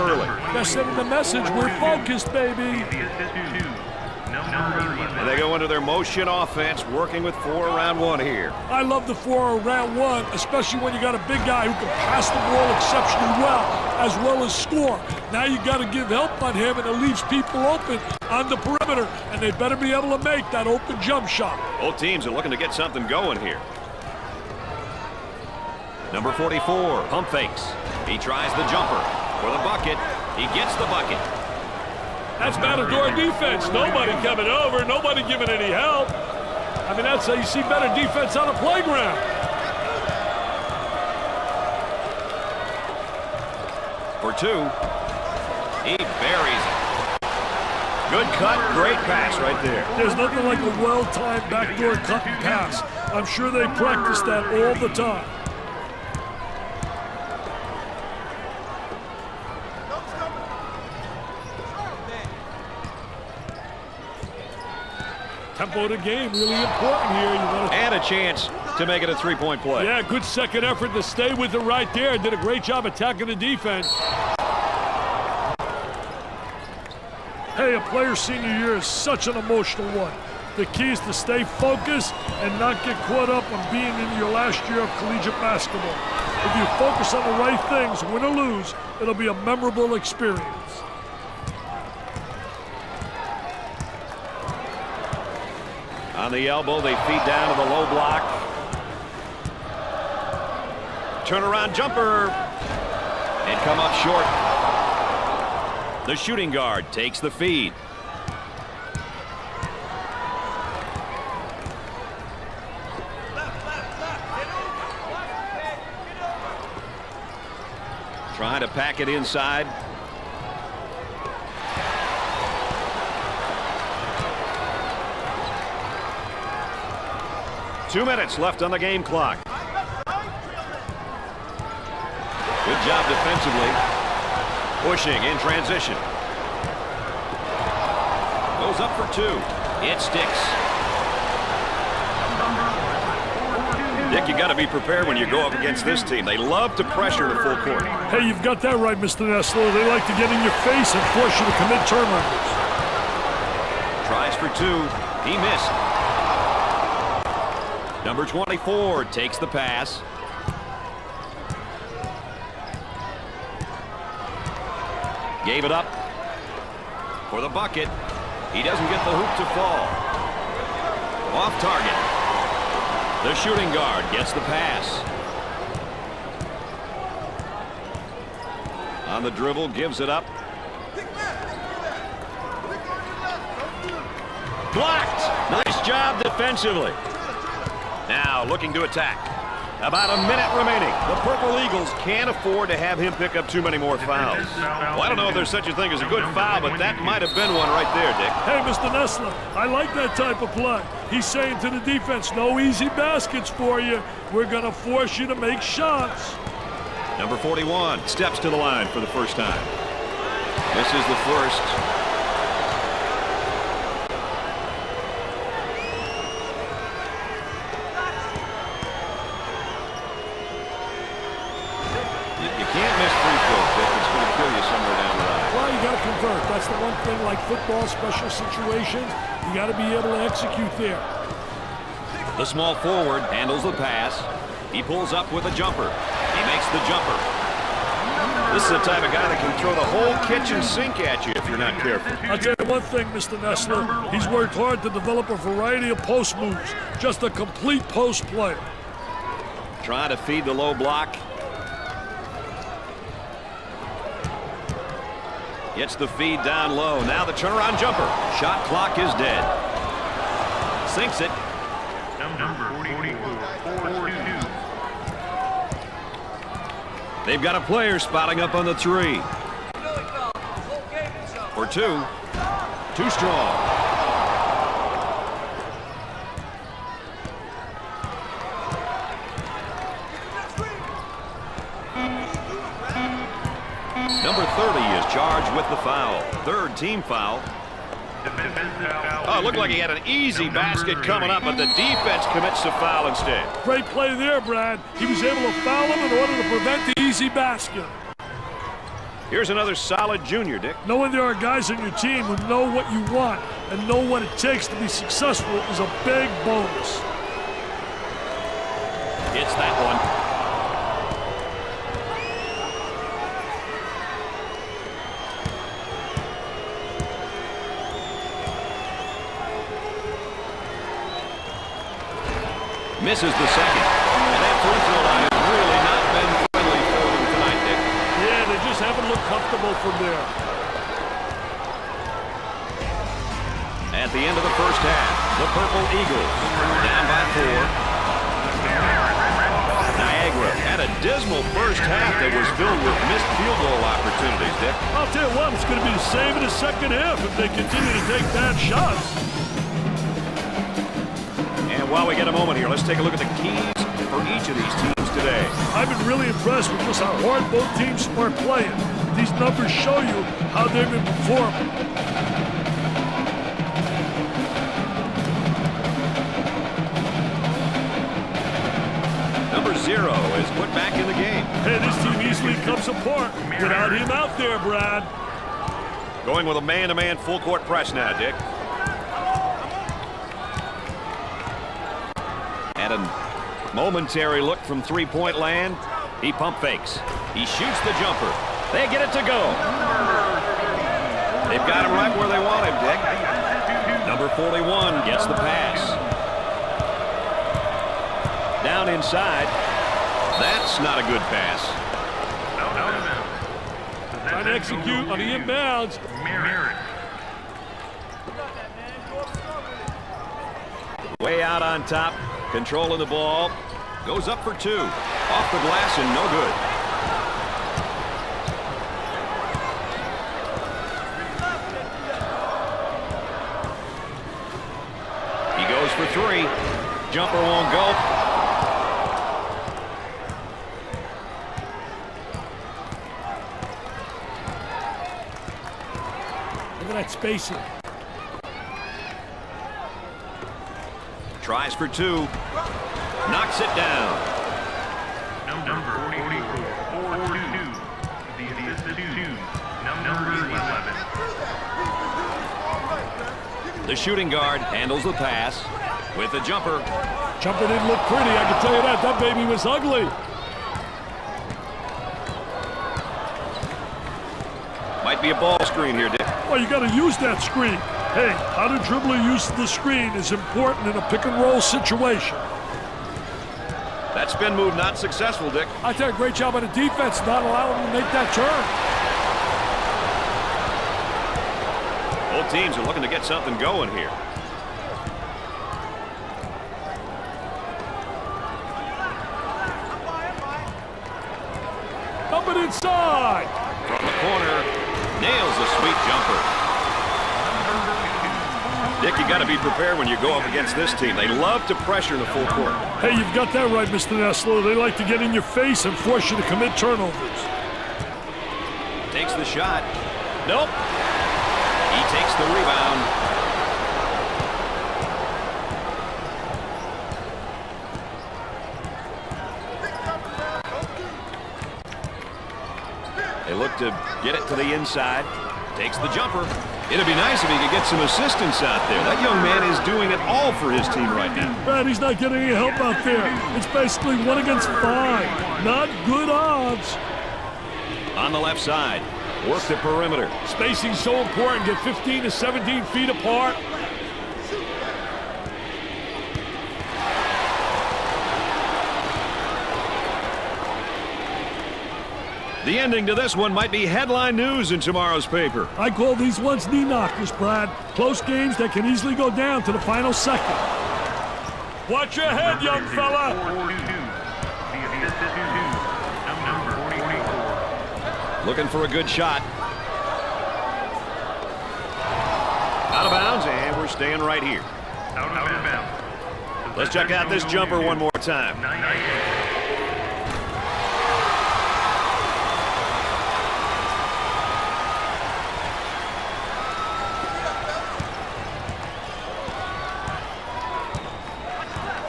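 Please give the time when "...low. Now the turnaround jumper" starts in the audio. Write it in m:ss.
4:16.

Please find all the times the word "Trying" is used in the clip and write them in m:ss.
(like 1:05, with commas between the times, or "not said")
1:58, 4:09, 6:44.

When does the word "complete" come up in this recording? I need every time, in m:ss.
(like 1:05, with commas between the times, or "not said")
4:07.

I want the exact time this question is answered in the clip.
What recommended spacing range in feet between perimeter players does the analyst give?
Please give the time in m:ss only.
9:01.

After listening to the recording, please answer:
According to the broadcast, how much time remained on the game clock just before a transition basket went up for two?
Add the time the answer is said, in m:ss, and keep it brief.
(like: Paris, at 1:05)
Two minutes, at 2:07.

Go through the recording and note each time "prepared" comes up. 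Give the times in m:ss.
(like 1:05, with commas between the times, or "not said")
2:24, 8:19.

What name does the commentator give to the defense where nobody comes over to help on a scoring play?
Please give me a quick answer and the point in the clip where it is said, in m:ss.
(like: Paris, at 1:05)
Matador defense, at 0:32.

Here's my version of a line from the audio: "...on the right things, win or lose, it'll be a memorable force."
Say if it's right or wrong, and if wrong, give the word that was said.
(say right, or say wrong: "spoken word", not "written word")
wrong: "experience", not "force".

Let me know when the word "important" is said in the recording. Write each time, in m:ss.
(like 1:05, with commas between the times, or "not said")
1:06, 7:50, 9:01.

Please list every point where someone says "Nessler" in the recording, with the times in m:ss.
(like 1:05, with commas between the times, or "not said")
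2:29, 3:18, 4:03, 8:24.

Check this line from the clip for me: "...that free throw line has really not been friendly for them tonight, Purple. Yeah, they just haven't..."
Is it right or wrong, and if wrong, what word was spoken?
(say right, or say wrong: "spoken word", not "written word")
wrong: "Dick", not "Purple".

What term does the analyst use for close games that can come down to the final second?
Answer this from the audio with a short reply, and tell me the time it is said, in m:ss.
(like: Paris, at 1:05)
knee knockers, at 9:16.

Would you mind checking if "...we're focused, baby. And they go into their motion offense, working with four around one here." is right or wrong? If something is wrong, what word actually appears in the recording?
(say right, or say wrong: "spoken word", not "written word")
right.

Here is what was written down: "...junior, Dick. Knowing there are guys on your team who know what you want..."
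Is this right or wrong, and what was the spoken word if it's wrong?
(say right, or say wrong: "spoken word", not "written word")
right.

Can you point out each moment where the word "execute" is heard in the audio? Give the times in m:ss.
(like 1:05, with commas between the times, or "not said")
3:50, 6:44.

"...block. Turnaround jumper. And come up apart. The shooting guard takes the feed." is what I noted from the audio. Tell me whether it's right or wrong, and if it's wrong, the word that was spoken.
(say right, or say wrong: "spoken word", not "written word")
wrong: "short", not "apart".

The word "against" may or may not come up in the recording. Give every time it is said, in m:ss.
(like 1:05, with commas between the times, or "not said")
2:25, 8:20, 8:54.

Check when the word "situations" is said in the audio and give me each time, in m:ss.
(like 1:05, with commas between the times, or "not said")
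3:48, 7:51.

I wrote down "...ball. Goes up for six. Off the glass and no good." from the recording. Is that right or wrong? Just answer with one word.
wrong.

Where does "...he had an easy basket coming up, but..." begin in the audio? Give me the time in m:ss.
4:49.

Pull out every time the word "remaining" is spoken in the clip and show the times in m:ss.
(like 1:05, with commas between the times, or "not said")
3:10.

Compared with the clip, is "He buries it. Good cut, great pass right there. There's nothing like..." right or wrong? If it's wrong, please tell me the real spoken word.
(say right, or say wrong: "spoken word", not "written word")
right.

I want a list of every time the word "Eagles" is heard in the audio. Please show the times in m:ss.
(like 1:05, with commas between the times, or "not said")
3:11, 5:35.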